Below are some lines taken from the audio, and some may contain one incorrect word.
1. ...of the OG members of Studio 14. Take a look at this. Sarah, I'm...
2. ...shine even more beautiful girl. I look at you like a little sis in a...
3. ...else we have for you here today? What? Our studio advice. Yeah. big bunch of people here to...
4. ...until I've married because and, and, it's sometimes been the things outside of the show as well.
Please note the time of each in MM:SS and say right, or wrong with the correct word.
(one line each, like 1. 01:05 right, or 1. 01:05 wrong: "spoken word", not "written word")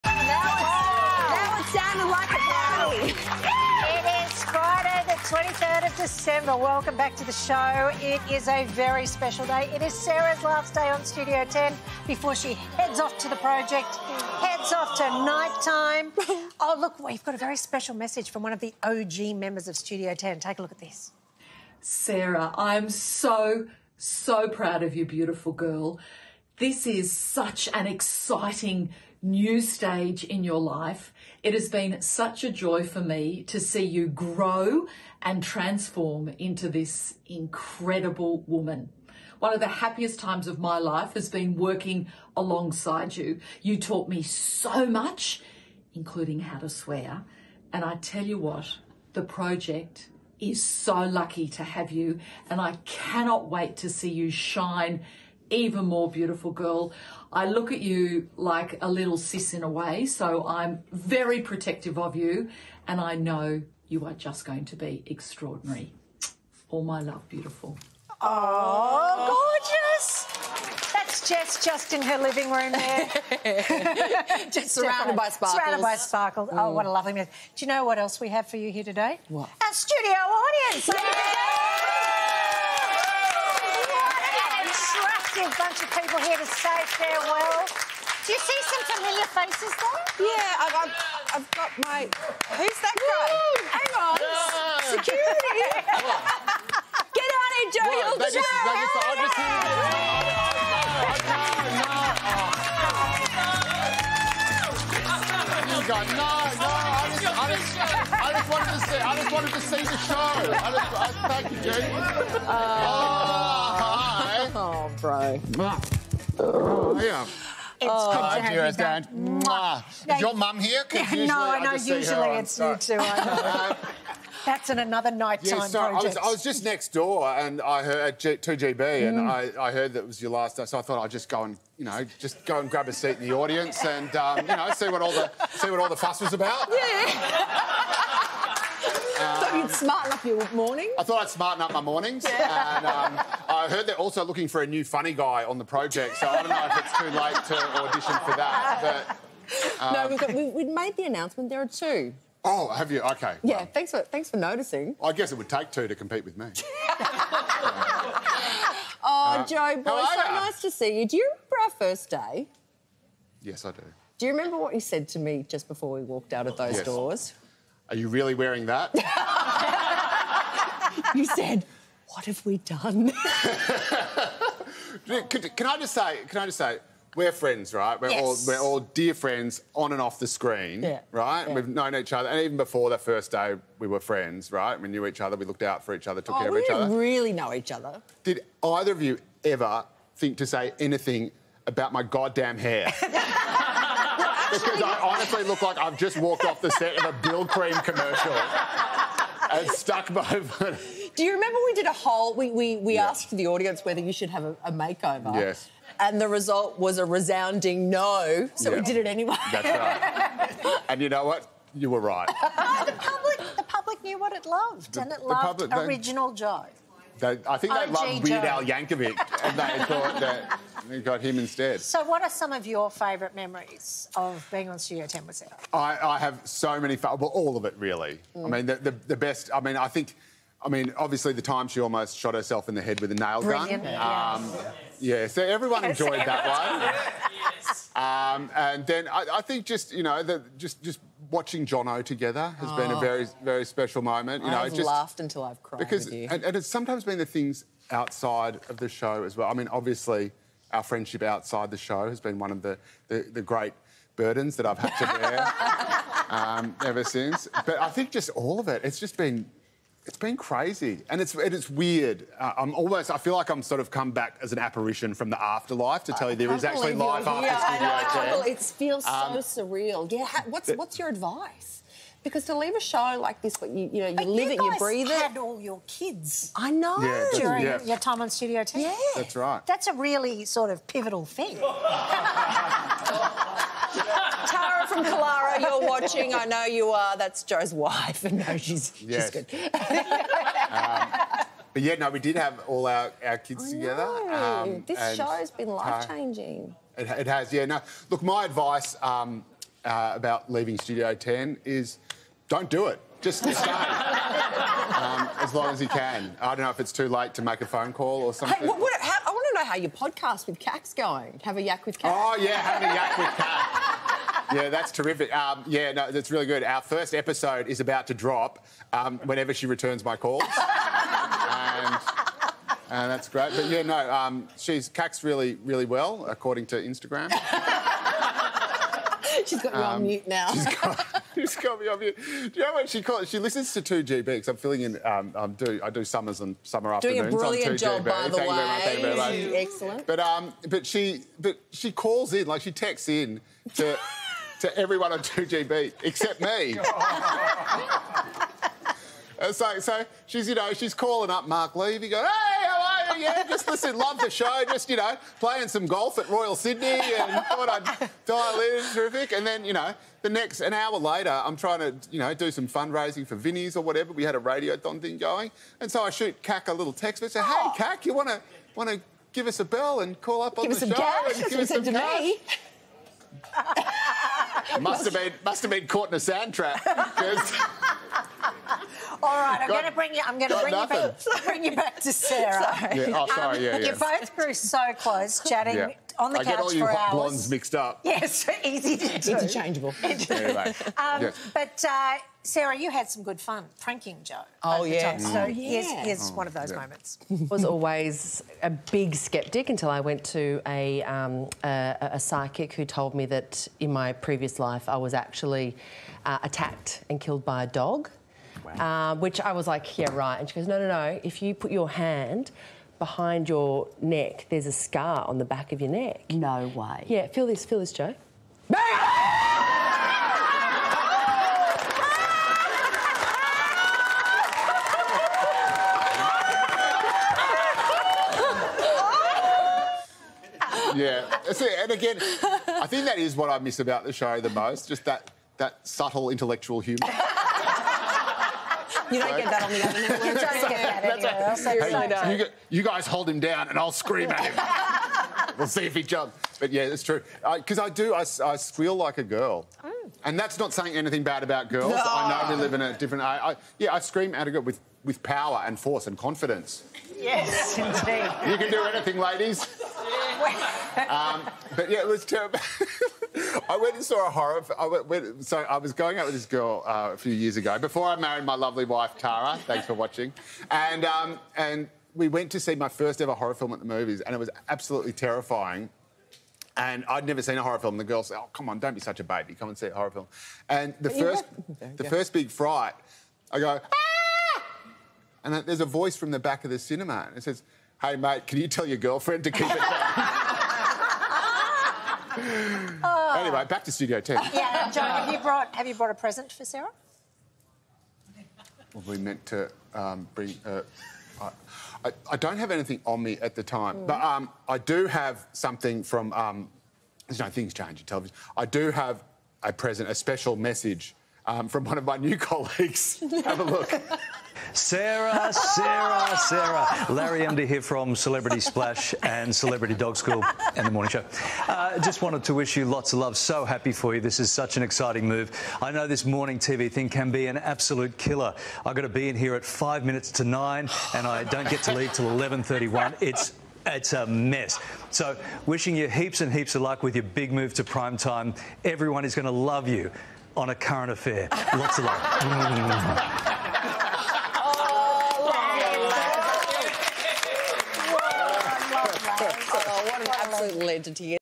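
1. 00:18 wrong: "10", not "14"
2. 00:54 right
3. 01:17 wrong: "audience", not "advice"
4. 04:05 wrong: "cried", not "married".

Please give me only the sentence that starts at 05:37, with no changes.
Doing a brilliant job, by the way.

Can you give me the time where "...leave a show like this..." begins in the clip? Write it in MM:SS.
04:32.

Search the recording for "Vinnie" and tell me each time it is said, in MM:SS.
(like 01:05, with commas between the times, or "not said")
06:03.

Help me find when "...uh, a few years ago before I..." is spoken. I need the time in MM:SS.
07:46.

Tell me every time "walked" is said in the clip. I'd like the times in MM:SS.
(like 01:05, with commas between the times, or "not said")
02:46, 03:16.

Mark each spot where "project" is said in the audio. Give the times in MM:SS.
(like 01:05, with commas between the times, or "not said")
00:13, 00:49, 02:05, 02:25.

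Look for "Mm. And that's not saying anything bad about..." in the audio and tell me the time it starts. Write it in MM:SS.
07:29.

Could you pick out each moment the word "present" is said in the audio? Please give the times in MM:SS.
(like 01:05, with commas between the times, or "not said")
08:16, 08:29.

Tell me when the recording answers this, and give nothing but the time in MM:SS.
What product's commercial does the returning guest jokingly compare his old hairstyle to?
03:17.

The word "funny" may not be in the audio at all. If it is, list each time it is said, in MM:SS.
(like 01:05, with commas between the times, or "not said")
02:24.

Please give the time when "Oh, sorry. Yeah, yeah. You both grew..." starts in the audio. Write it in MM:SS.
06:23.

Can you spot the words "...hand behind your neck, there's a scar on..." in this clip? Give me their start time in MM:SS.
06:51.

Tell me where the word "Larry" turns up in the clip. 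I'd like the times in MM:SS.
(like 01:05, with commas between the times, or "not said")
08:37.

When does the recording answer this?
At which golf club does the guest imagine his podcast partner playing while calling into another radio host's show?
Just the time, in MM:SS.
05:56.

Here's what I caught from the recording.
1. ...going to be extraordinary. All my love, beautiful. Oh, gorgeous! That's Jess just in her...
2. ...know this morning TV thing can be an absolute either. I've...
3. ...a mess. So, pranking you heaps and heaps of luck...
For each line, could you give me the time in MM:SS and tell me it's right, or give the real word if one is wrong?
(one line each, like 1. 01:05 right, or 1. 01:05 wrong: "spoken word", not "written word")
1. 01:04 right
2. 08:45 wrong: "killer", not "either"
3. 08:54 wrong: "wishing", not "pranking".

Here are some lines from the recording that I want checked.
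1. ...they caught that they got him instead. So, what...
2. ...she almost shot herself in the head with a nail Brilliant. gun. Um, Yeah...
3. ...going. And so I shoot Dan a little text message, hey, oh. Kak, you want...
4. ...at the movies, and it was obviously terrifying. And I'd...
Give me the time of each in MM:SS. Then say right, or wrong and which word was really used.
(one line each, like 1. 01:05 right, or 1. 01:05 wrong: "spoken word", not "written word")
1. 03:39 wrong: "thought", not "caught"
2. 03:51 right
3. 06:05 wrong: "Kak", not "Dan"
4. 07:53 wrong: "absolutely", not "obviously".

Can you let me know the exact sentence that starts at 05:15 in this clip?
Um, yeah, no, that's really good.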